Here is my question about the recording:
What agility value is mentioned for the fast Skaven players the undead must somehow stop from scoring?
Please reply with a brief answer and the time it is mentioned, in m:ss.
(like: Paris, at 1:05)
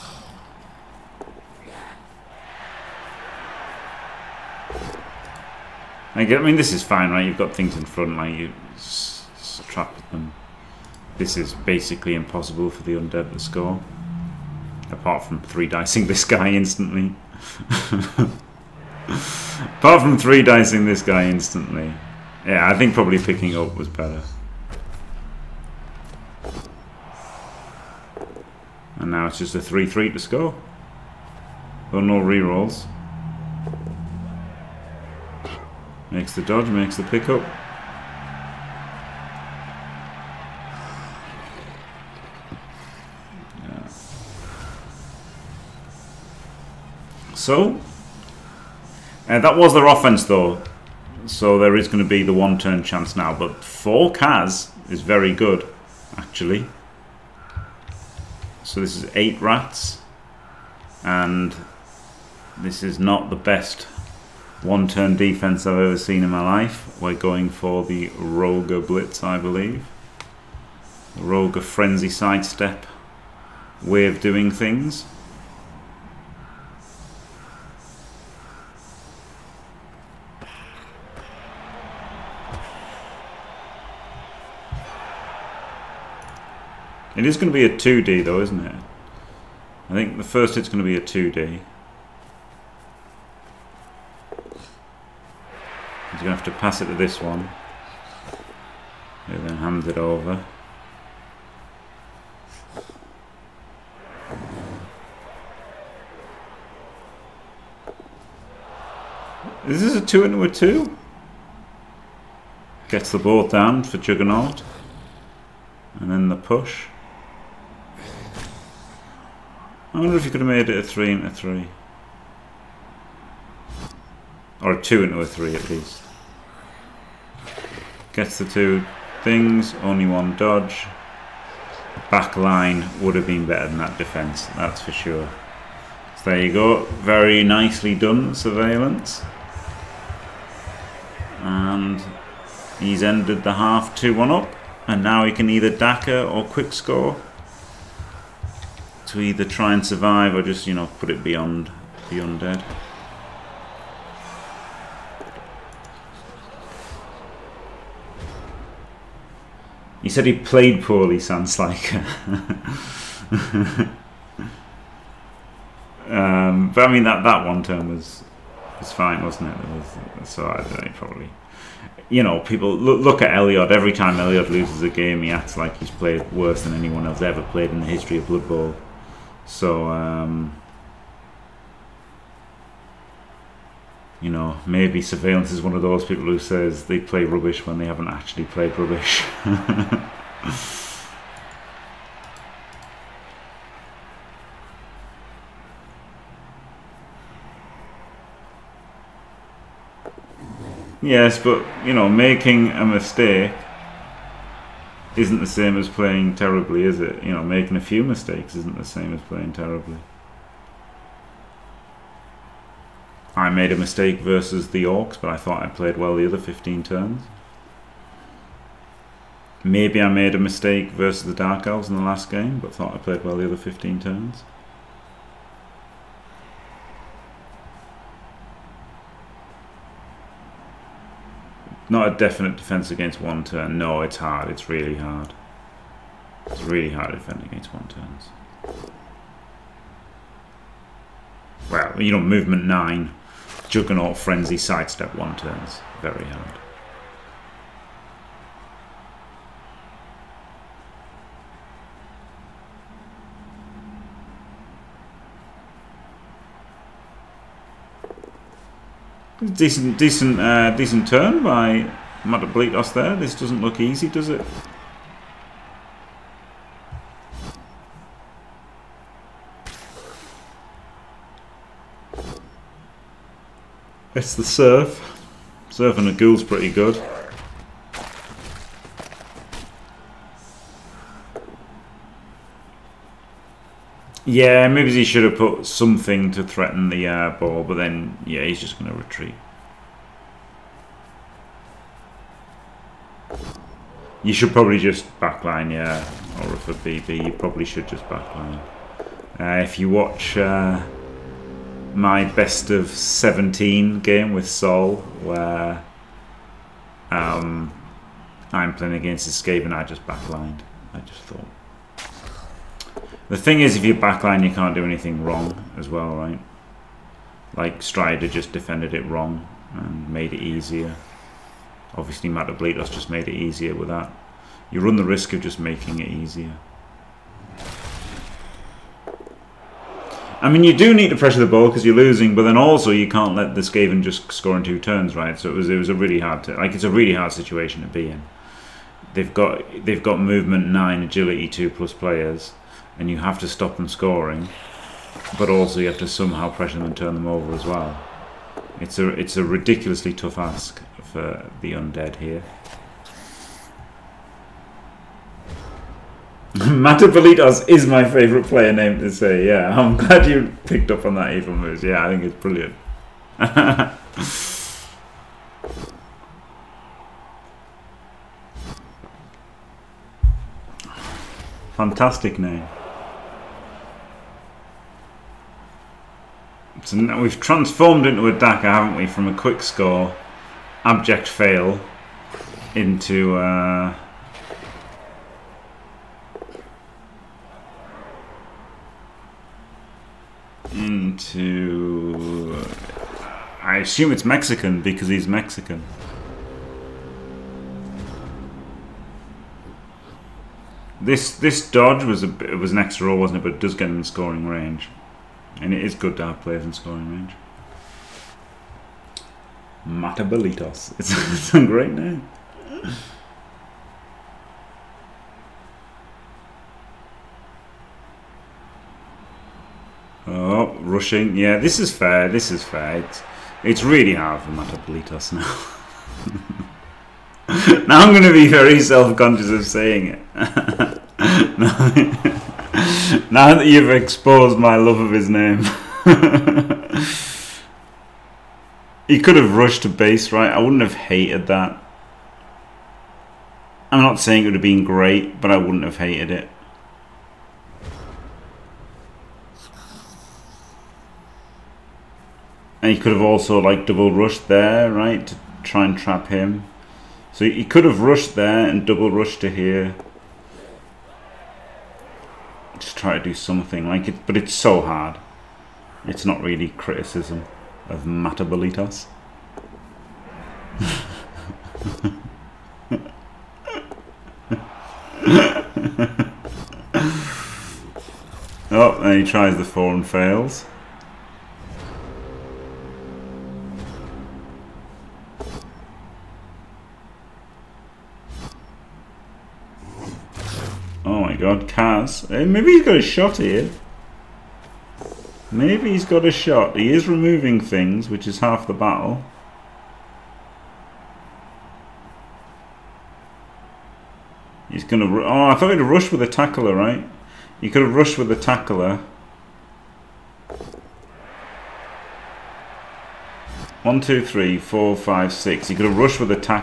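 2+, at 5:41.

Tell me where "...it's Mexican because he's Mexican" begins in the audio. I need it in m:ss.
6:34.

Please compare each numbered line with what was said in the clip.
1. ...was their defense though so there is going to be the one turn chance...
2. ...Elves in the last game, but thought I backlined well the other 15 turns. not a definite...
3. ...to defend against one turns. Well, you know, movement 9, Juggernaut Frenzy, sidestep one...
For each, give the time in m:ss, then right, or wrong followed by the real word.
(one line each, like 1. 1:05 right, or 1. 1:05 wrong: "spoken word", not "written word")
1. 0:49 wrong: "offense", not "defense"
2. 3:41 wrong: "played", not "backlined"
3. 3:57 right.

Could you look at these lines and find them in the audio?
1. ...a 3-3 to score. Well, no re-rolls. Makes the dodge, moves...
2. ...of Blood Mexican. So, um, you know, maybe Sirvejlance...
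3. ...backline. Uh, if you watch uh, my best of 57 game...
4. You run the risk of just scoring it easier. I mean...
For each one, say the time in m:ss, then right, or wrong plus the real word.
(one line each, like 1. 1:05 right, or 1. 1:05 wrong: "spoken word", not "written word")
1. 0:29 wrong: "makes", not "moves"
2. 2:58 wrong: "Bowl", not "Mexican"
3. 4:58 wrong: "17", not "57"
4. 5:24 wrong: "making", not "scoring".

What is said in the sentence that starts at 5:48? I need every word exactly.
It's a it's a ridiculously tough ask for the undead here.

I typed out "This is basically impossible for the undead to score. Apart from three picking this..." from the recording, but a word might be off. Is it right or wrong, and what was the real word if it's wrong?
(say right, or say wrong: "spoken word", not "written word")
wrong: "dicing", not "picking".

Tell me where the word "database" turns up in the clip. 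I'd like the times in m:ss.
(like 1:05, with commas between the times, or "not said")
not said.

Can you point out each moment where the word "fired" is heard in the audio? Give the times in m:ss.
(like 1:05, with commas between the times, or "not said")
not said.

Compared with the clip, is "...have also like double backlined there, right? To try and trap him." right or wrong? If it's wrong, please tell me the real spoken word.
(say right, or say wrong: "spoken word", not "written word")
wrong: "rushed", not "backlined".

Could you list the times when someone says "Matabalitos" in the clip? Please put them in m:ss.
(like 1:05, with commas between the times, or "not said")
4:22, 5:22, 5:56, 6:49, 7:04, 7:48.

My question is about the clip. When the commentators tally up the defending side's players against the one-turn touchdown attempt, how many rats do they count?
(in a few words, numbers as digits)
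8.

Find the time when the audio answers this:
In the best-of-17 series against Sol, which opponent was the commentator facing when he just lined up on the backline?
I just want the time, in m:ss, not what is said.
5:09.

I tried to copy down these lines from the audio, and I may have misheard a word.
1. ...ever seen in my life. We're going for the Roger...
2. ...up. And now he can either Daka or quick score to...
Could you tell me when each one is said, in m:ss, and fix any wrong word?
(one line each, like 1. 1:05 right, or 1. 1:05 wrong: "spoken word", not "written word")
1. 1:05 right
2. 2:24 right.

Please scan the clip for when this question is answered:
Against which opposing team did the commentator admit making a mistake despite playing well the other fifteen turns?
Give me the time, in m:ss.
3:34.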